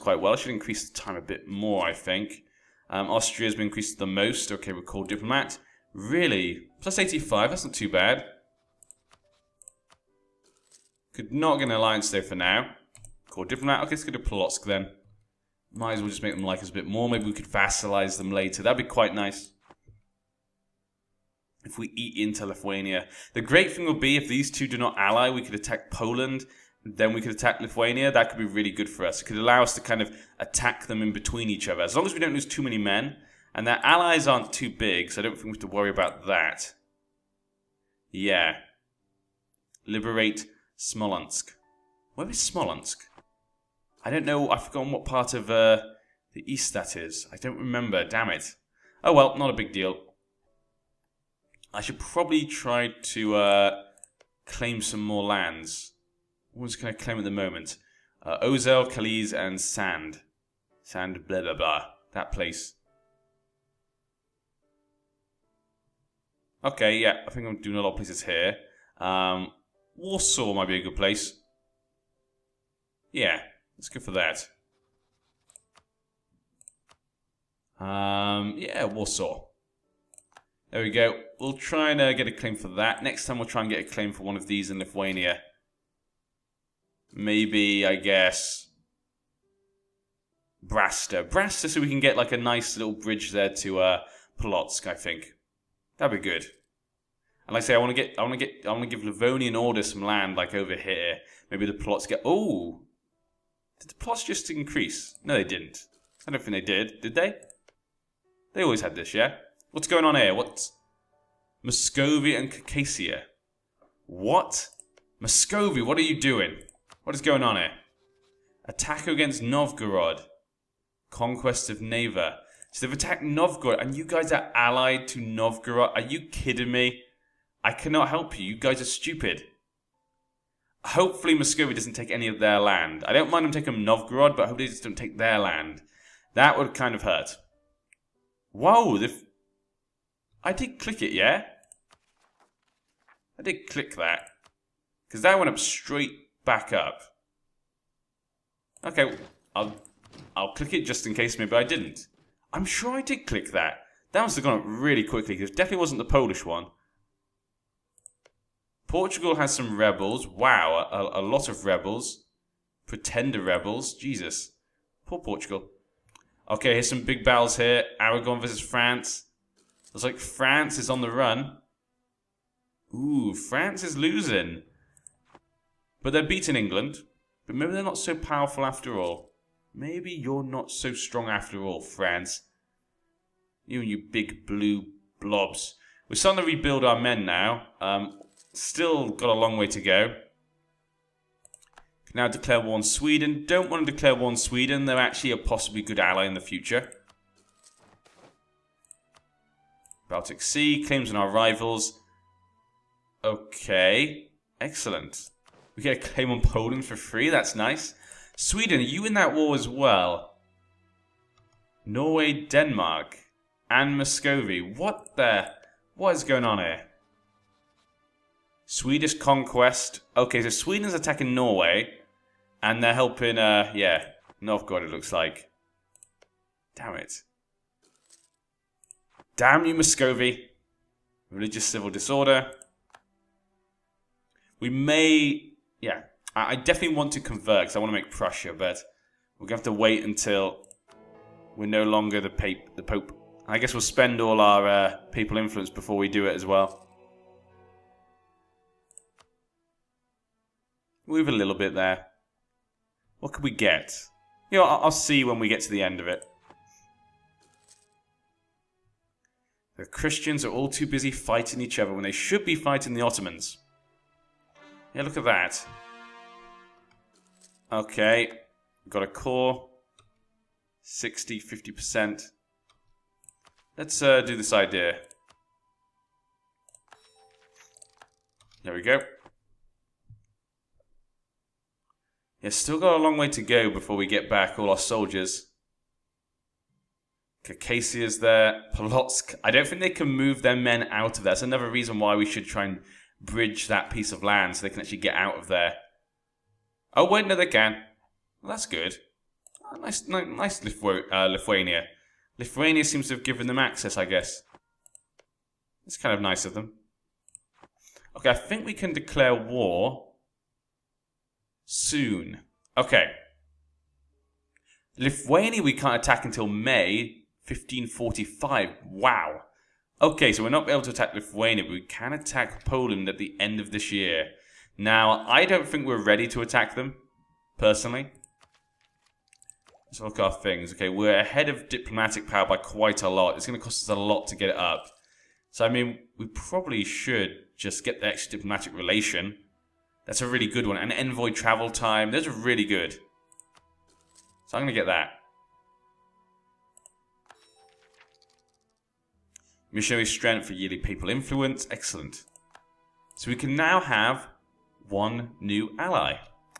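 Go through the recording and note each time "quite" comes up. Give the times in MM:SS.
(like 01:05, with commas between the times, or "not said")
00:18, 05:32.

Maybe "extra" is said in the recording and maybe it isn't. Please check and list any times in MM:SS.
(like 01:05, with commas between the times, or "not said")
05:38.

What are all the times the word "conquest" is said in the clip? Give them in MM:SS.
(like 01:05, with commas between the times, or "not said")
02:01, 03:39.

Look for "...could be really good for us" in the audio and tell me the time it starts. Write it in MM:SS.
00:28.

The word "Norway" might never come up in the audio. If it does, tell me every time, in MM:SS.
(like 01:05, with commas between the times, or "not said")
03:31, 03:41.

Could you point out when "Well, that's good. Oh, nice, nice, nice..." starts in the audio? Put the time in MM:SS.
04:58.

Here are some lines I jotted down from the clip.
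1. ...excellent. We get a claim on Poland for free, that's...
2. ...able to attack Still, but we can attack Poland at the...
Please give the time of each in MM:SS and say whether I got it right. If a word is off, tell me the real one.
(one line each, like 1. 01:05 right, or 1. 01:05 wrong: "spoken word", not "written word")
1. 03:24 right
2. 05:20 wrong: "Lithuania", not "Still".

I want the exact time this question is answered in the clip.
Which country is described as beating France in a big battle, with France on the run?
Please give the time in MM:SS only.
02:48.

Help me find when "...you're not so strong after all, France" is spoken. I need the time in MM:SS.
03:00.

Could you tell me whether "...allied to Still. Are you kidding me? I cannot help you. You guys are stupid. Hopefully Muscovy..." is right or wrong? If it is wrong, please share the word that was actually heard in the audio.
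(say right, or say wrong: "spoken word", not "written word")
wrong: "Novgorod", not "Still".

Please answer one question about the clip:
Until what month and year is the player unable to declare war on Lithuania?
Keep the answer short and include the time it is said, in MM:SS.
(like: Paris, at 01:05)
May 1545, at 05:16.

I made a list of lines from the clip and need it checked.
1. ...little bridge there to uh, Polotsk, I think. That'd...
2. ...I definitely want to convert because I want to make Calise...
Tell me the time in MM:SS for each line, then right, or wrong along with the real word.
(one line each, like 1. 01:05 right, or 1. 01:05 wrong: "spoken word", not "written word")
1. 01:32 right
2. 03:56 wrong: "Prussia", not "Calise".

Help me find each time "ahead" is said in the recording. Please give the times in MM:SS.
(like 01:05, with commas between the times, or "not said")
05:31.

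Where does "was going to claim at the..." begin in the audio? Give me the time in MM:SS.
00:56.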